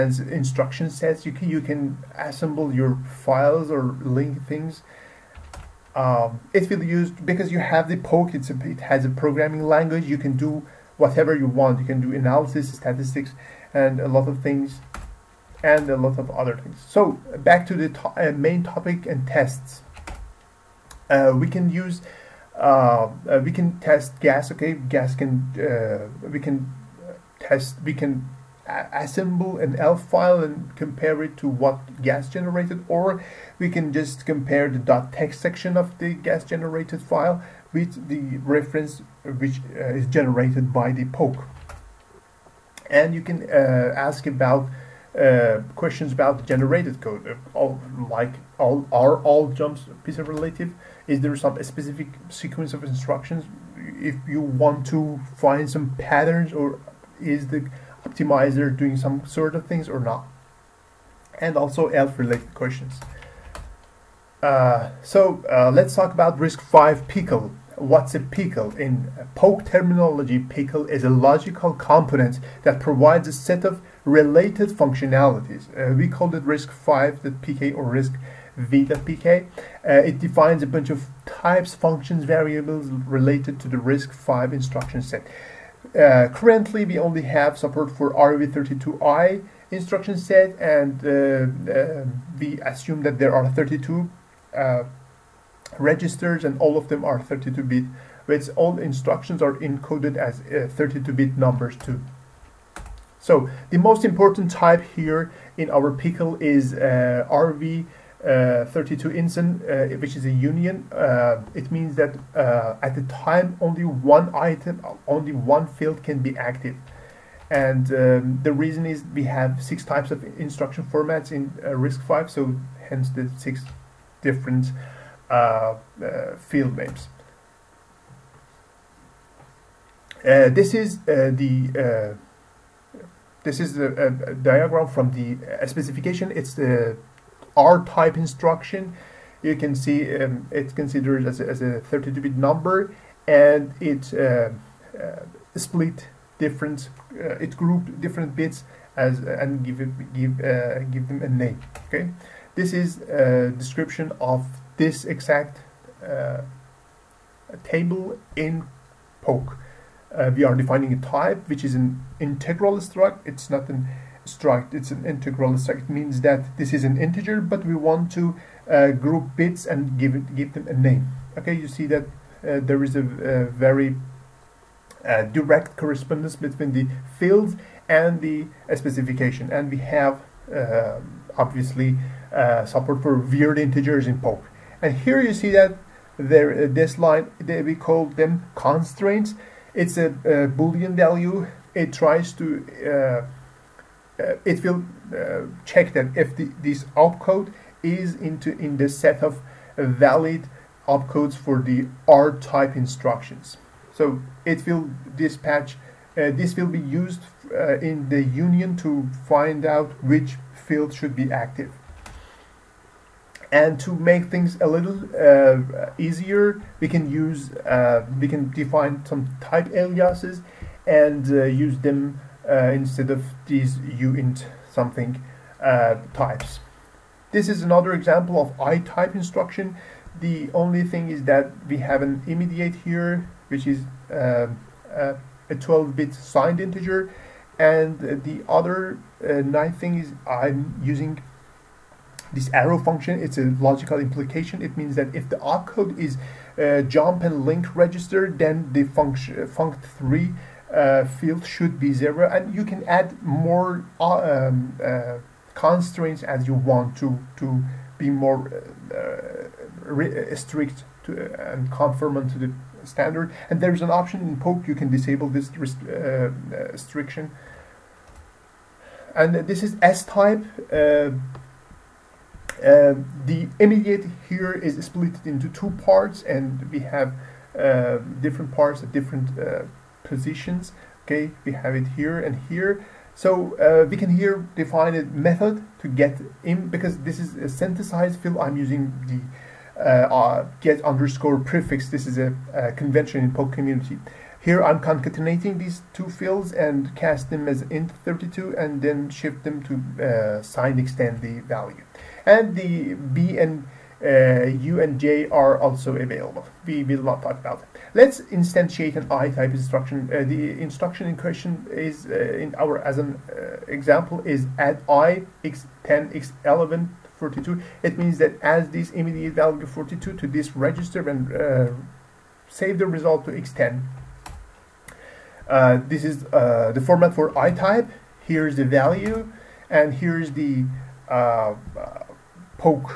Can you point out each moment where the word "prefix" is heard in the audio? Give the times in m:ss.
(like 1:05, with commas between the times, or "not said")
4:51.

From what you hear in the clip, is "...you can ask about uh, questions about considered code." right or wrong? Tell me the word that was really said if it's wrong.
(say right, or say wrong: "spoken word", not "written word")
wrong: "generated", not "considered".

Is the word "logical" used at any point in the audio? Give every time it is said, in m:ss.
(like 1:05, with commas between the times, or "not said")
1:11, 4:03.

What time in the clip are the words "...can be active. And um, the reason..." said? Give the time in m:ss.
1:56.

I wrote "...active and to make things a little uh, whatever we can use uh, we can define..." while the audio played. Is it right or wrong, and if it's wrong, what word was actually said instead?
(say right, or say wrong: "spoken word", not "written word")
wrong: "easier", not "whatever".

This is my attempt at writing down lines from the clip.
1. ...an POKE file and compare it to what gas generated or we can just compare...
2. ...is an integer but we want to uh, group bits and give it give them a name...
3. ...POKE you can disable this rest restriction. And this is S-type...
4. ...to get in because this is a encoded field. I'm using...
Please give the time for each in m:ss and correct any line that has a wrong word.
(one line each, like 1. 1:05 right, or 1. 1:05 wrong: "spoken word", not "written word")
1. 0:29 wrong: "ELF", not "POKE"
2. 2:46 right
3. 4:24 right
4. 4:45 wrong: "synthesized", not "encoded".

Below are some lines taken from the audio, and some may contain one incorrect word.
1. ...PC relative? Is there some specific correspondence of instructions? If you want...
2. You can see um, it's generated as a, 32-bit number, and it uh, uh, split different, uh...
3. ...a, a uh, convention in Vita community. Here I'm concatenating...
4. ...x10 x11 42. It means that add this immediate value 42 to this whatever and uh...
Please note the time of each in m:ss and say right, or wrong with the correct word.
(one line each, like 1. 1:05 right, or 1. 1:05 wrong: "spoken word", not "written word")
1. 0:50 wrong: "sequence", not "correspondence"
2. 2:19 wrong: "considered", not "generated"
3. 4:52 wrong: "Poke", not "Vita"
4. 5:15 wrong: "register", not "whatever".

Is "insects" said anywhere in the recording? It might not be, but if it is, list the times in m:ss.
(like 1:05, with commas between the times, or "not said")
not said.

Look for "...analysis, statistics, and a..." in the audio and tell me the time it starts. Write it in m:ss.
0:12.